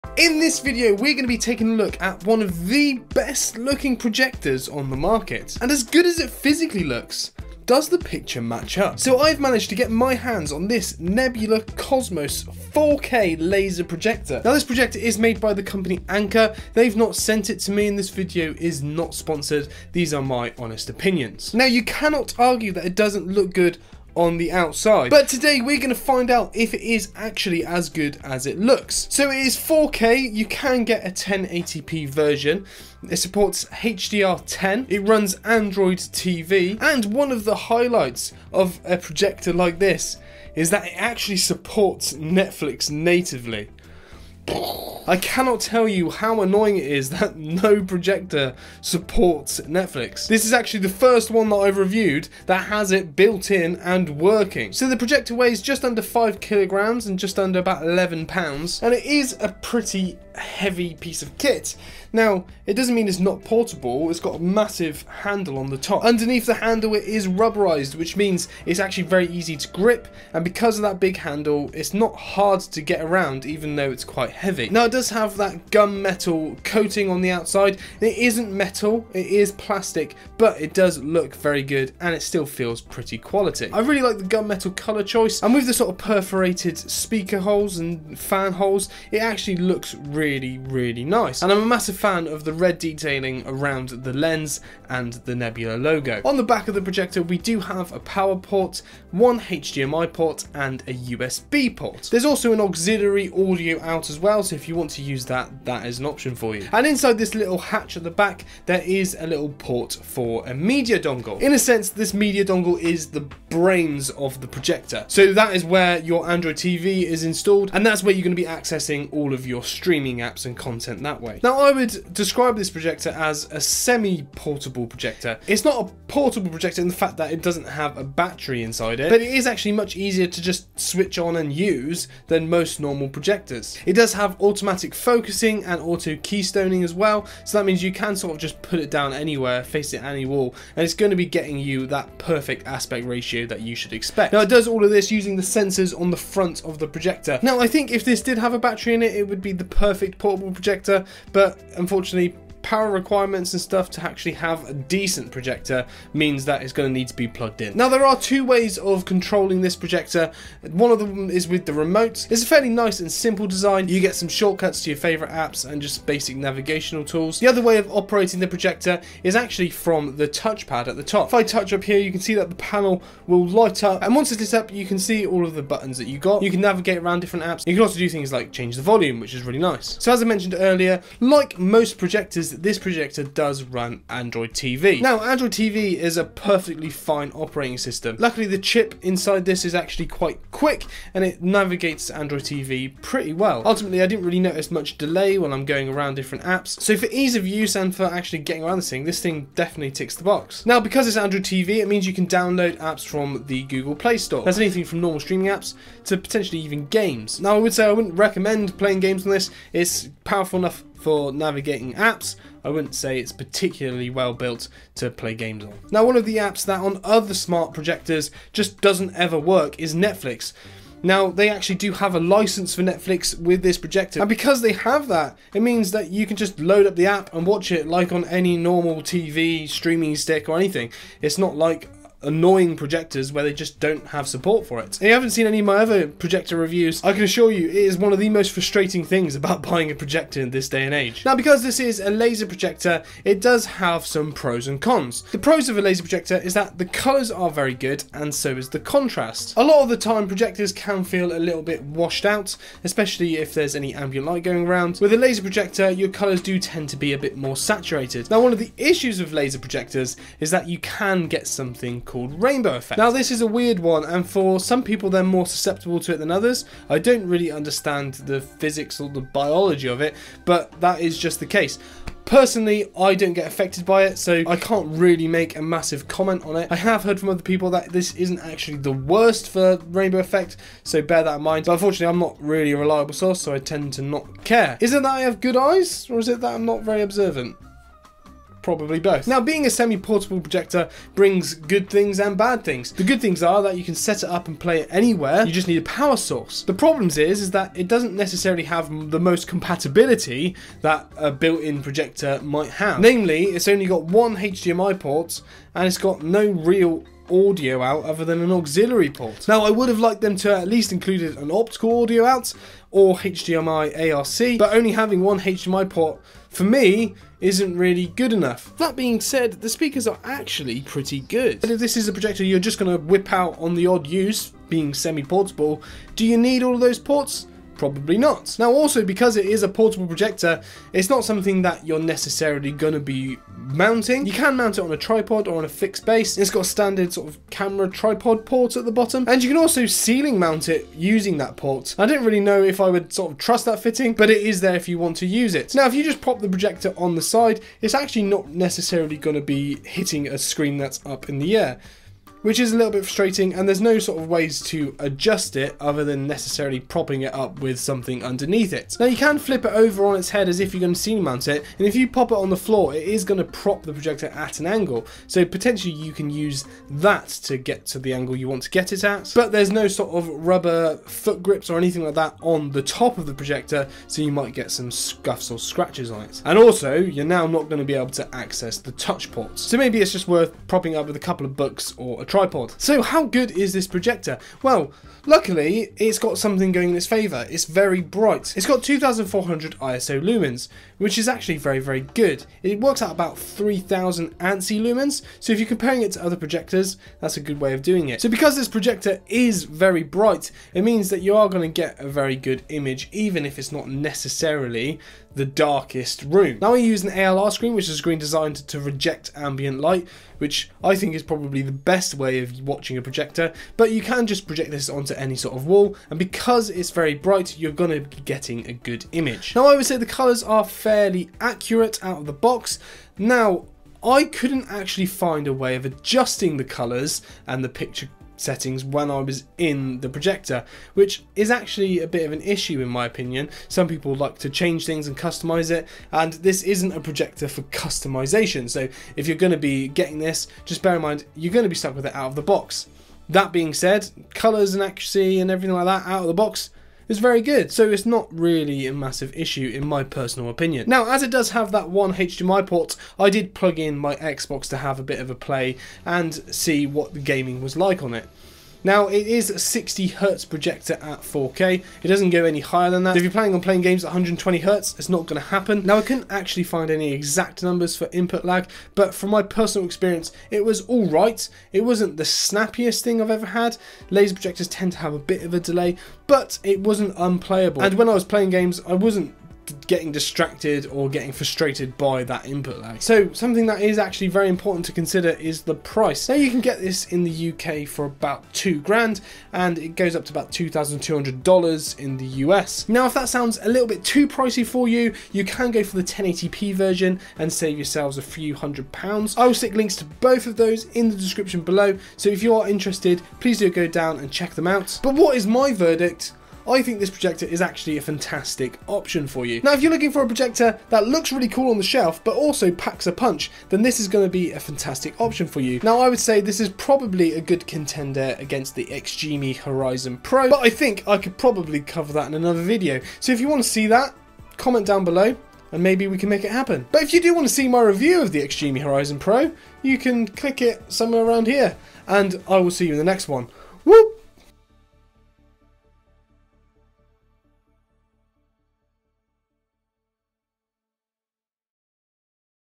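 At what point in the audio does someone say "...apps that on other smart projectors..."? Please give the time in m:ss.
3:36.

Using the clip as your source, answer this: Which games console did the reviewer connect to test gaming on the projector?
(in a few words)
Xbox.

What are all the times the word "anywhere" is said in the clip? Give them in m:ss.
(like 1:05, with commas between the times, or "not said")
2:19, 4:54.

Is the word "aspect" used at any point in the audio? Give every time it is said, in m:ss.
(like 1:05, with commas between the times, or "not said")
2:22.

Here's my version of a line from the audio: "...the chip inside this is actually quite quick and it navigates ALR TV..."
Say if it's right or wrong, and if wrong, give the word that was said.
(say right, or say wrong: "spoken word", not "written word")
wrong: "Android", not "ALR".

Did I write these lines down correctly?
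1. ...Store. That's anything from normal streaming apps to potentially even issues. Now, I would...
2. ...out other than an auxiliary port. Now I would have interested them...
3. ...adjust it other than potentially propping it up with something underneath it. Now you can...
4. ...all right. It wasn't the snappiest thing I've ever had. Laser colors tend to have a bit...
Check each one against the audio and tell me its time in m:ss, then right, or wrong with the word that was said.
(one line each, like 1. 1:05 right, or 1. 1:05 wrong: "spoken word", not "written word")
1. 3:24 wrong: "games", not "issues"
2. 5:07 wrong: "liked", not "interested"
3. 5:54 wrong: "necessarily", not "potentially"
4. 7:50 wrong: "projectors", not "colors".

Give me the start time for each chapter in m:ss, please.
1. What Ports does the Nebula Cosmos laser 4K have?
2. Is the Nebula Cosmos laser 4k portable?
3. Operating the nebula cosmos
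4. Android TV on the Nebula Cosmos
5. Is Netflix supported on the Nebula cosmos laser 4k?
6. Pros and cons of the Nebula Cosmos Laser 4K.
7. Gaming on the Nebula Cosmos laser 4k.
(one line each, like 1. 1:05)
1. 1:36
2. 2:01
3. 2:37
4. 3:00
5. 3:36
6. 4:00
7. 7:31.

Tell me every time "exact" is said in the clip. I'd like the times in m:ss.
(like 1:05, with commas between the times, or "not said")
7:47.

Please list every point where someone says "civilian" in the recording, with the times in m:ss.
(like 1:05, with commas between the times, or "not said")
not said.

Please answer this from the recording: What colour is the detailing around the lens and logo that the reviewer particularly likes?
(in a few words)
Red.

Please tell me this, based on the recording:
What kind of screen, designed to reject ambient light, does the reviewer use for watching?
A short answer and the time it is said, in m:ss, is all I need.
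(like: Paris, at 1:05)
ALR screen, at 6:47.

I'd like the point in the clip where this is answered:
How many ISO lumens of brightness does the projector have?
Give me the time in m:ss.
6:28.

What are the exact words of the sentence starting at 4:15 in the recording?
With a laser projector, your colours do tend to be a bit more saturated.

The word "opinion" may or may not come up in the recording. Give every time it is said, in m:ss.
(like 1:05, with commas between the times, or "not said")
0:20, 7:13, 7:30.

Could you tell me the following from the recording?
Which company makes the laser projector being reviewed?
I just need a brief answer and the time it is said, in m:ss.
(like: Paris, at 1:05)
Anker, at 0:16.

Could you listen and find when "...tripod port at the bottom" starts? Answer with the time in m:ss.
5:37.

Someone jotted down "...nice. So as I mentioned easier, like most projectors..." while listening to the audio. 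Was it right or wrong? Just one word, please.
wrong.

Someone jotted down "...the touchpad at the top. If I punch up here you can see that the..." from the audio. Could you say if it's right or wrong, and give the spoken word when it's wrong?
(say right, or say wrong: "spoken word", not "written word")
wrong: "touch", not "punch".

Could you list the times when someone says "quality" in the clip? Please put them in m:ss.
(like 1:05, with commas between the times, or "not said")
1:23.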